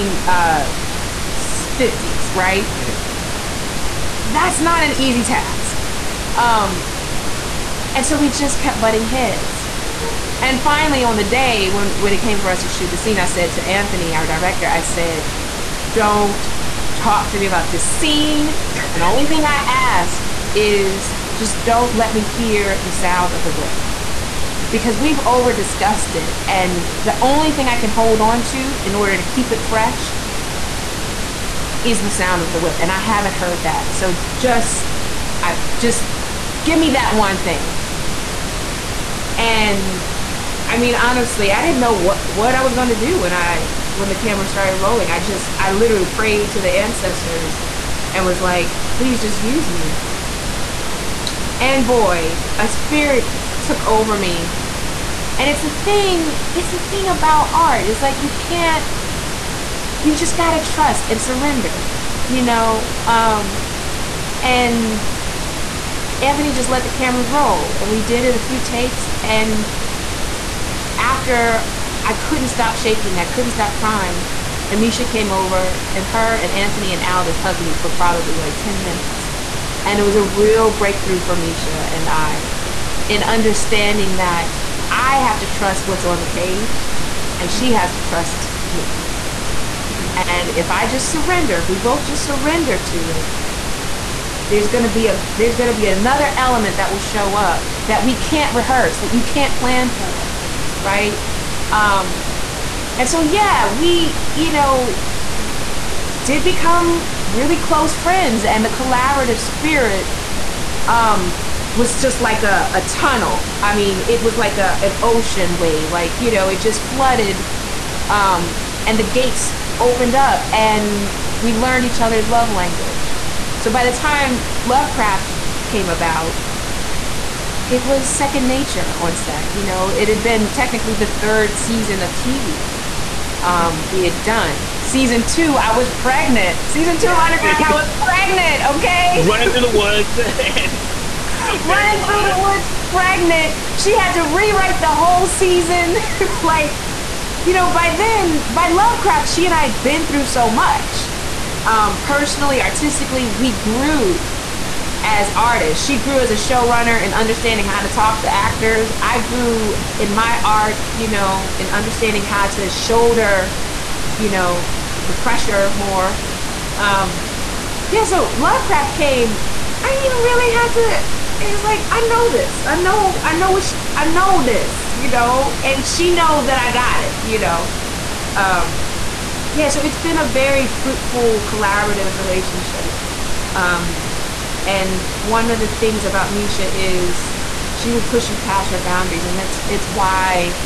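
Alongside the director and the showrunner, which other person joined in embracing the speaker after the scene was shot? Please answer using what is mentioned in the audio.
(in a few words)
Aldis.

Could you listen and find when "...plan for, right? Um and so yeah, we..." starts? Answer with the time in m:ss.
1:39.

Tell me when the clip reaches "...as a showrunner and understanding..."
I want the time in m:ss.
2:36.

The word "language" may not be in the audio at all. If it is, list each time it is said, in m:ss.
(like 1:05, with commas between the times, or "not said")
2:02.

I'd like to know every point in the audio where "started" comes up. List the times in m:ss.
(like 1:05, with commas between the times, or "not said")
0:44.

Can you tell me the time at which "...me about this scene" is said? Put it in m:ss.
0:17.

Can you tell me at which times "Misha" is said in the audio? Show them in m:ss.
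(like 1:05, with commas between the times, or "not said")
1:14, 1:21, 3:06.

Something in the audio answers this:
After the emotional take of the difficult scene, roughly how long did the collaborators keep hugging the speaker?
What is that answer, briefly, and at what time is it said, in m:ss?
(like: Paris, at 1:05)
10 minutes, at 1:18.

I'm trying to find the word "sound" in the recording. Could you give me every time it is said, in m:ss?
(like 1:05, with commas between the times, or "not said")
0:22, 0:32.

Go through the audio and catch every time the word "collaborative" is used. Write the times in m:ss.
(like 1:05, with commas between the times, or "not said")
1:48, 3:01.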